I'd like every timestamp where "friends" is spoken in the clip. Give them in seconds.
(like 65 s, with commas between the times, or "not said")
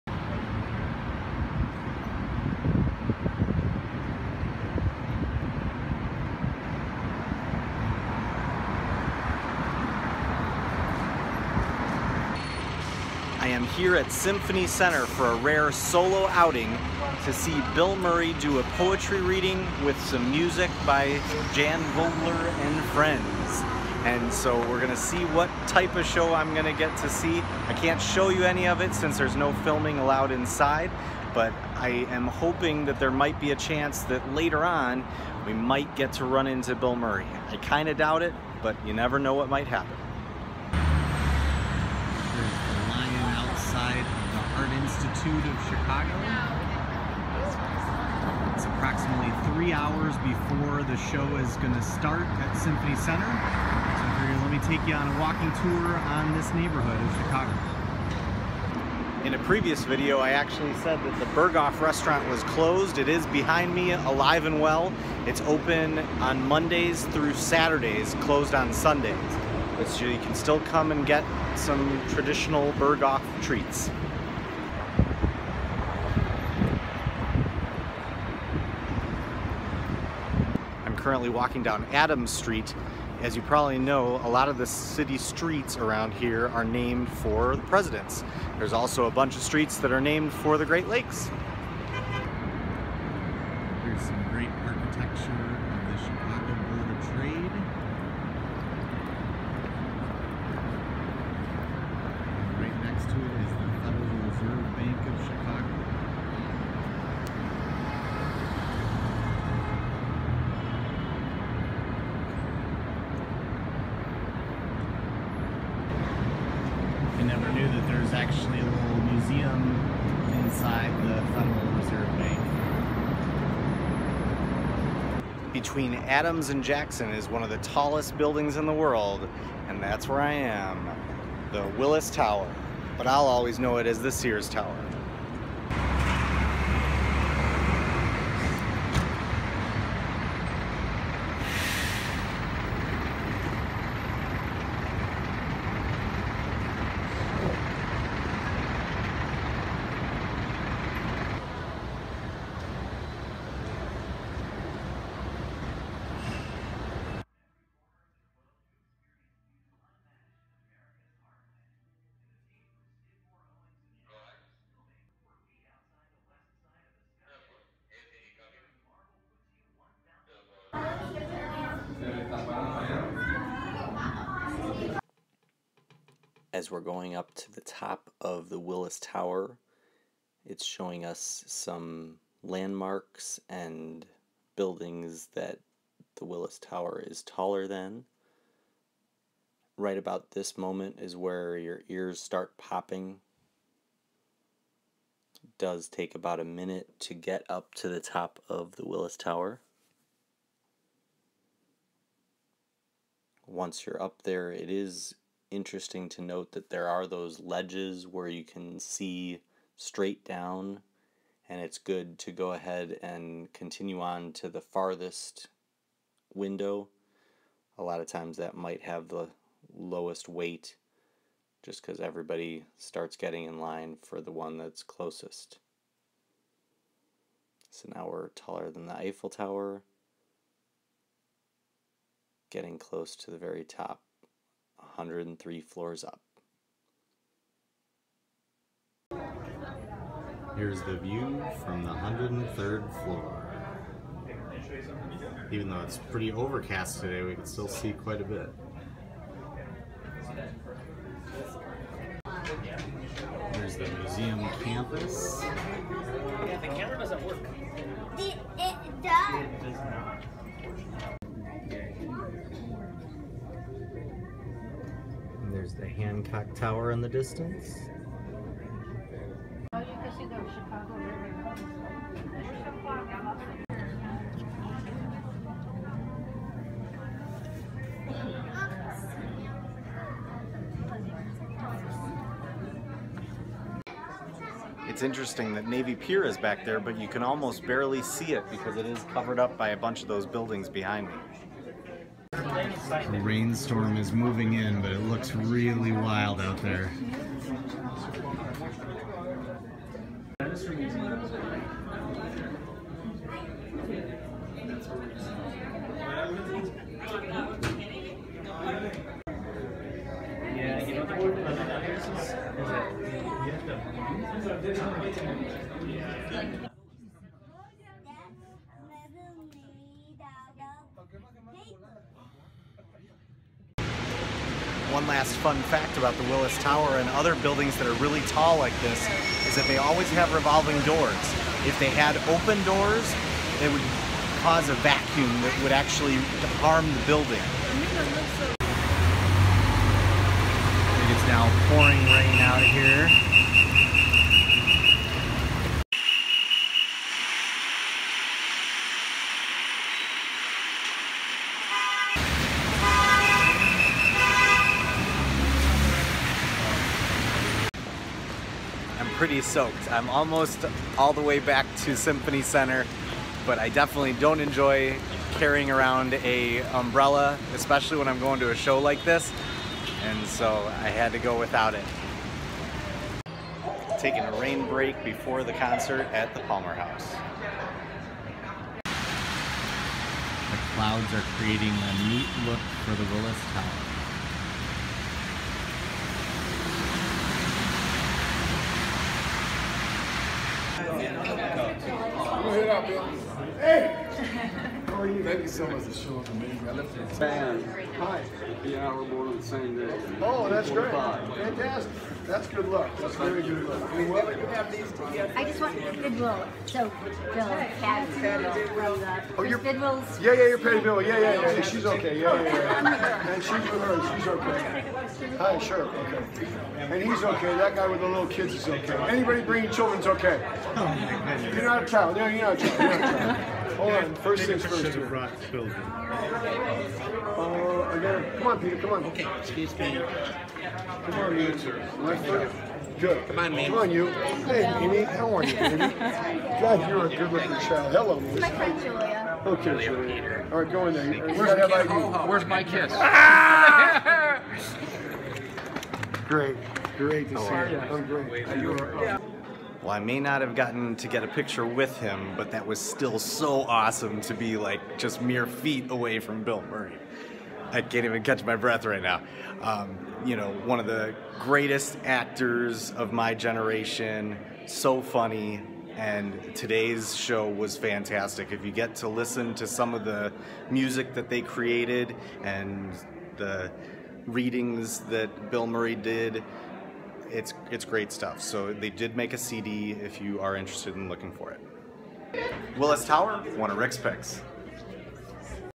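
22 s, 438 s.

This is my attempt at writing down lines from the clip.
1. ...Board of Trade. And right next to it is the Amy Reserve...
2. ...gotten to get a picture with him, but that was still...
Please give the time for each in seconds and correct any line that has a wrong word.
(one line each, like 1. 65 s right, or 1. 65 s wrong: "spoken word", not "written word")
1. 96 s wrong: "Federal", not "Amy"
2. 450 s right.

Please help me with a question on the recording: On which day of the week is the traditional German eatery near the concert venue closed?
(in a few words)
Sundays.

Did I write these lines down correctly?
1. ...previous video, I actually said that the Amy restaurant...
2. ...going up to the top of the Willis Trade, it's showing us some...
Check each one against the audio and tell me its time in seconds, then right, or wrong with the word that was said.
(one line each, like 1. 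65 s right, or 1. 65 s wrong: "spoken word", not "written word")
1. 59 s wrong: "Berghoff", not "Amy"
2. 176 s wrong: "Tower", not "Trade".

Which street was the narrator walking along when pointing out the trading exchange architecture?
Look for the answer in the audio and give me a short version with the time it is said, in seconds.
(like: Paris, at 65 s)
Adams Street, at 81 s.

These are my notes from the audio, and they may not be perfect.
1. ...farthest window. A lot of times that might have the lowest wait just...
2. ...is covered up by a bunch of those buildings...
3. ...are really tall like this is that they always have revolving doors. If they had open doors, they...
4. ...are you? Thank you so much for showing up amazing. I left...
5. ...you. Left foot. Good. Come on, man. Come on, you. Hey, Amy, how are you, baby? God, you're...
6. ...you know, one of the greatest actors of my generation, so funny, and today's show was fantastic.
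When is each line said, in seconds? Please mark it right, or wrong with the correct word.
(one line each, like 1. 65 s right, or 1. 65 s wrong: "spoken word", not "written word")
1. 214 s right
2. 288 s right
3. 327 s right
4. 395 s right
5. 431 s right
6. 460 s right.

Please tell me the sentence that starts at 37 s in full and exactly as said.
I kinda doubt it, but you never know what might happen.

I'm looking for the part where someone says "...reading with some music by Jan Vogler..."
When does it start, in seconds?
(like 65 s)
19 s.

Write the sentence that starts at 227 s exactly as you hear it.
So now we're taller than the Eiffel Tower, getting close to the very top.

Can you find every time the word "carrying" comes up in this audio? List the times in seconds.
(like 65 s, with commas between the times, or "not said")
365 s.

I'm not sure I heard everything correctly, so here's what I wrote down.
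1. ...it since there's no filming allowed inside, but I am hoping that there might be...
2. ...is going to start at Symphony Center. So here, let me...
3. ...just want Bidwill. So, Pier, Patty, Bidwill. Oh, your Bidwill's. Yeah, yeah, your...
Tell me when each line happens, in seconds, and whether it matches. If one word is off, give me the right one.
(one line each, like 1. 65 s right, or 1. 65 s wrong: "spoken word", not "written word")
1. 28 s right
2. 51 s right
3. 405 s wrong: "Bill", not "Pier".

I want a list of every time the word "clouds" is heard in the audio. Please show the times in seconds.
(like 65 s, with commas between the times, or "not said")
380 s.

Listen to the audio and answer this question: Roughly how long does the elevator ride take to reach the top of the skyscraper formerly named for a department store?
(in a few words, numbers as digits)
About a minute.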